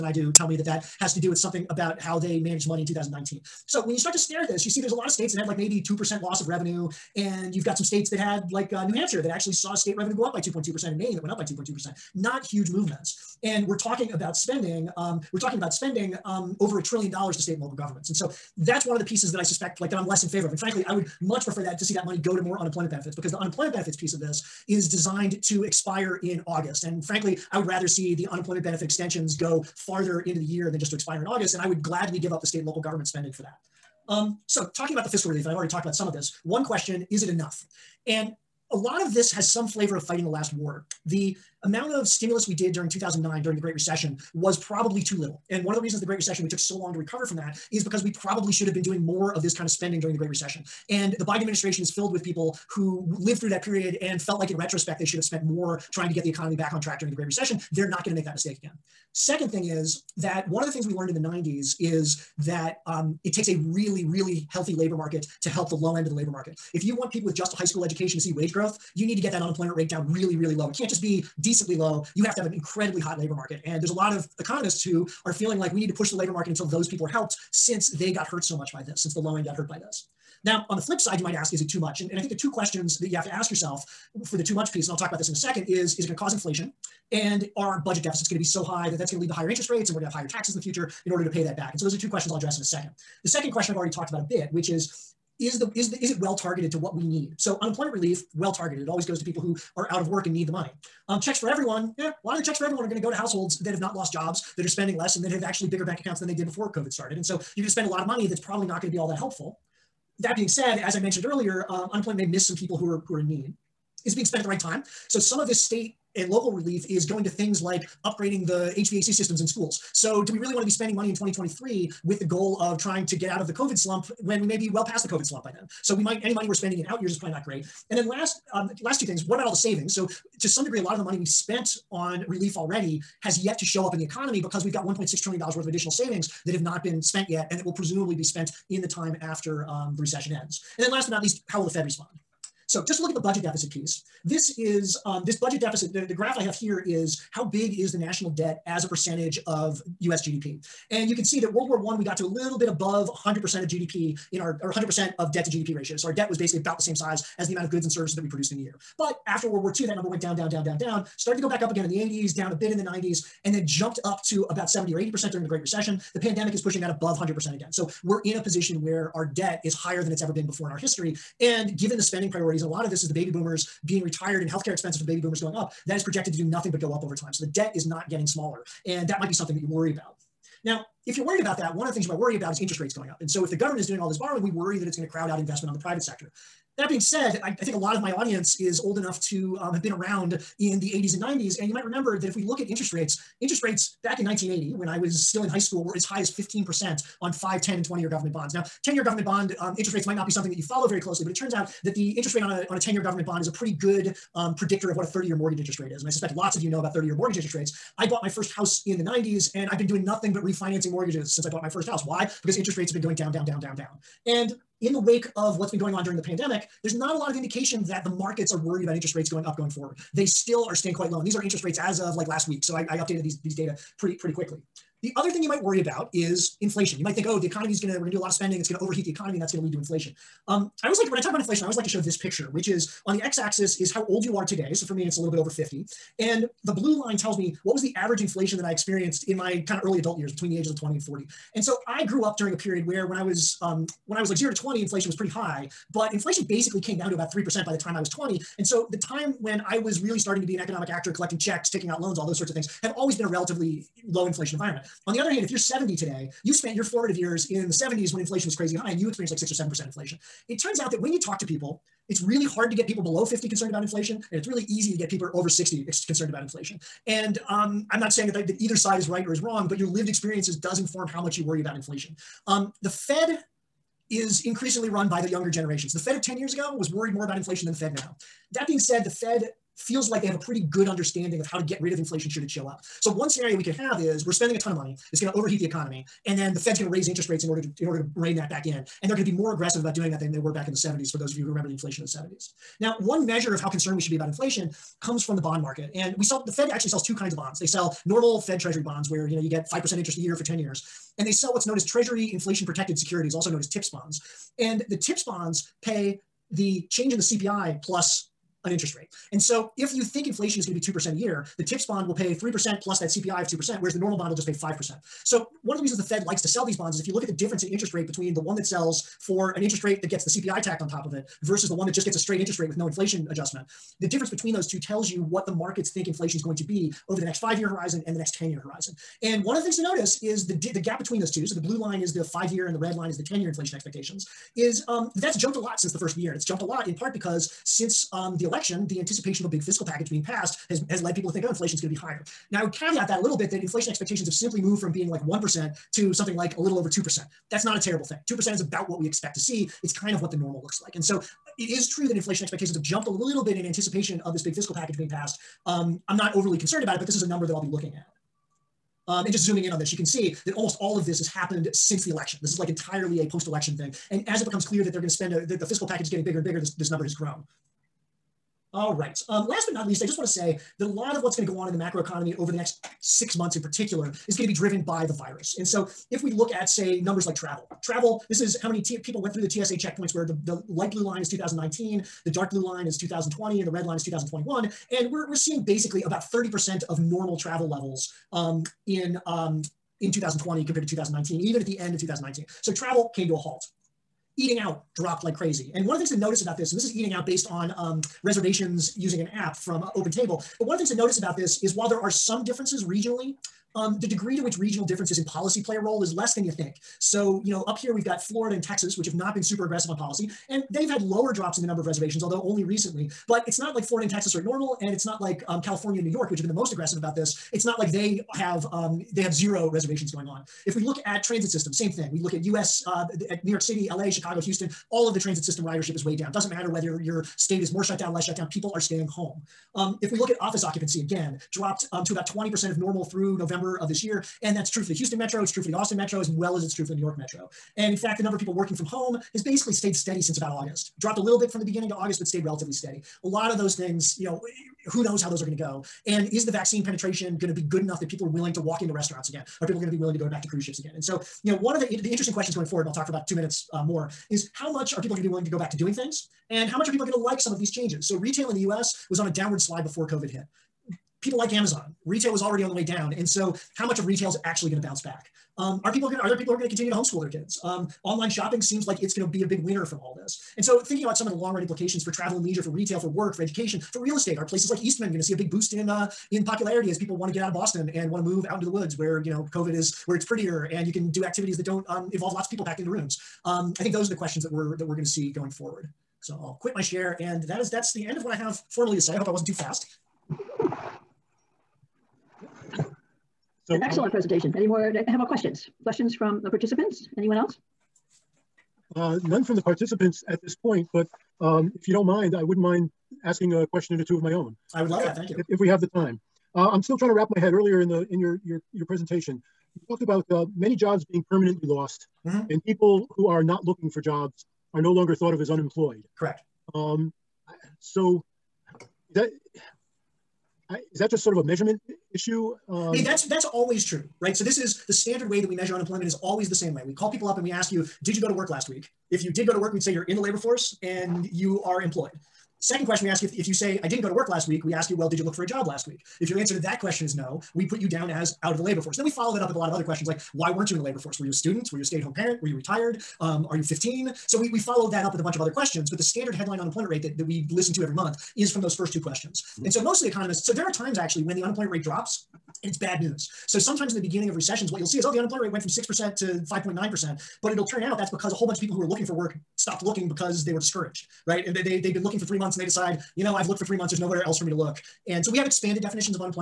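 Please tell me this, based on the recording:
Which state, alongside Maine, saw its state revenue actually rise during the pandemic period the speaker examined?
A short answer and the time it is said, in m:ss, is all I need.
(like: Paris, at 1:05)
New Hampshire, at 0:08.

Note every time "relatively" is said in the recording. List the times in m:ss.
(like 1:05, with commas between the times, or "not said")
4:13, 7:22.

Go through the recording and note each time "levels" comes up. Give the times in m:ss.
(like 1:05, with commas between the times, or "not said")
6:27.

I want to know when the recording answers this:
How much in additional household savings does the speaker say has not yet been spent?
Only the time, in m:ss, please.
2:14.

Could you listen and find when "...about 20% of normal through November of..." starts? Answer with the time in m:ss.
7:12.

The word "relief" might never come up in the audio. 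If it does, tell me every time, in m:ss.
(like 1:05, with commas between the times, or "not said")
0:35, 1:37, 1:56, 2:12.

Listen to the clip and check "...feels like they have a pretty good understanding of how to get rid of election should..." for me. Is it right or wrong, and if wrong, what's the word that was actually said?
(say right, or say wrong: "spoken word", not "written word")
wrong: "inflation", not "election".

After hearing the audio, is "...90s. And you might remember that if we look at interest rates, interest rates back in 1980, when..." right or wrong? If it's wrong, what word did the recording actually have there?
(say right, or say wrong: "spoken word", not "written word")
right.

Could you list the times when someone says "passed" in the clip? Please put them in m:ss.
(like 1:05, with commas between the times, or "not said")
5:40, 5:55.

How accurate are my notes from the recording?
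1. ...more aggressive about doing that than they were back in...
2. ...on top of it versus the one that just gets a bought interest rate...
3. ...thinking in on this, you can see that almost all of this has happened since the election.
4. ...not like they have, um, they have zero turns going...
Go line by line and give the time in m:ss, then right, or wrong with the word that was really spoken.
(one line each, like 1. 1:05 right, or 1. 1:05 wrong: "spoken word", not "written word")
1. 4:49 right
2. 5:20 wrong: "straight", not "bought"
3. 5:59 wrong: "zooming", not "thinking"
4. 6:57 wrong: "reservations", not "turns".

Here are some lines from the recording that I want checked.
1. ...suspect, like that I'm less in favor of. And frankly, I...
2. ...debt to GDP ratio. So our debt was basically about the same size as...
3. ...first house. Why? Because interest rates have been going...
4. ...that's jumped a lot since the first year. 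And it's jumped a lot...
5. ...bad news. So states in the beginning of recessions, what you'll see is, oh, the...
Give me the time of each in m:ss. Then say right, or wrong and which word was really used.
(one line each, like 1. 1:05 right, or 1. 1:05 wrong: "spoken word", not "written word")
1. 0:19 right
2. 2:35 right
3. 3:31 right
4. 5:35 right
5. 9:12 wrong: "sometimes", not "states".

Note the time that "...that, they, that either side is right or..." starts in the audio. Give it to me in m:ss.
4:28.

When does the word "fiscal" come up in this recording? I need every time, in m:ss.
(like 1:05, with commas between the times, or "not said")
0:35, 5:39, 5:54, 6:05.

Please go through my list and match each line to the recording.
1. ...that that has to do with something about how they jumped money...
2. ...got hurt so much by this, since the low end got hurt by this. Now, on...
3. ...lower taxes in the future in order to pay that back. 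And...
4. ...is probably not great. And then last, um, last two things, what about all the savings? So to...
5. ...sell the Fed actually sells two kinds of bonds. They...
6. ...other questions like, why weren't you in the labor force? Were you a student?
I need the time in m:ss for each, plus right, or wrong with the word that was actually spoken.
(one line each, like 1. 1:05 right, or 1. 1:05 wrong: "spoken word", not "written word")
1. 0:00 wrong: "managed", not "jumped"
2. 1:18 right
3. 1:30 wrong: "higher", not "lower"
4. 2:07 right
5. 4:56 right
6. 8:59 right.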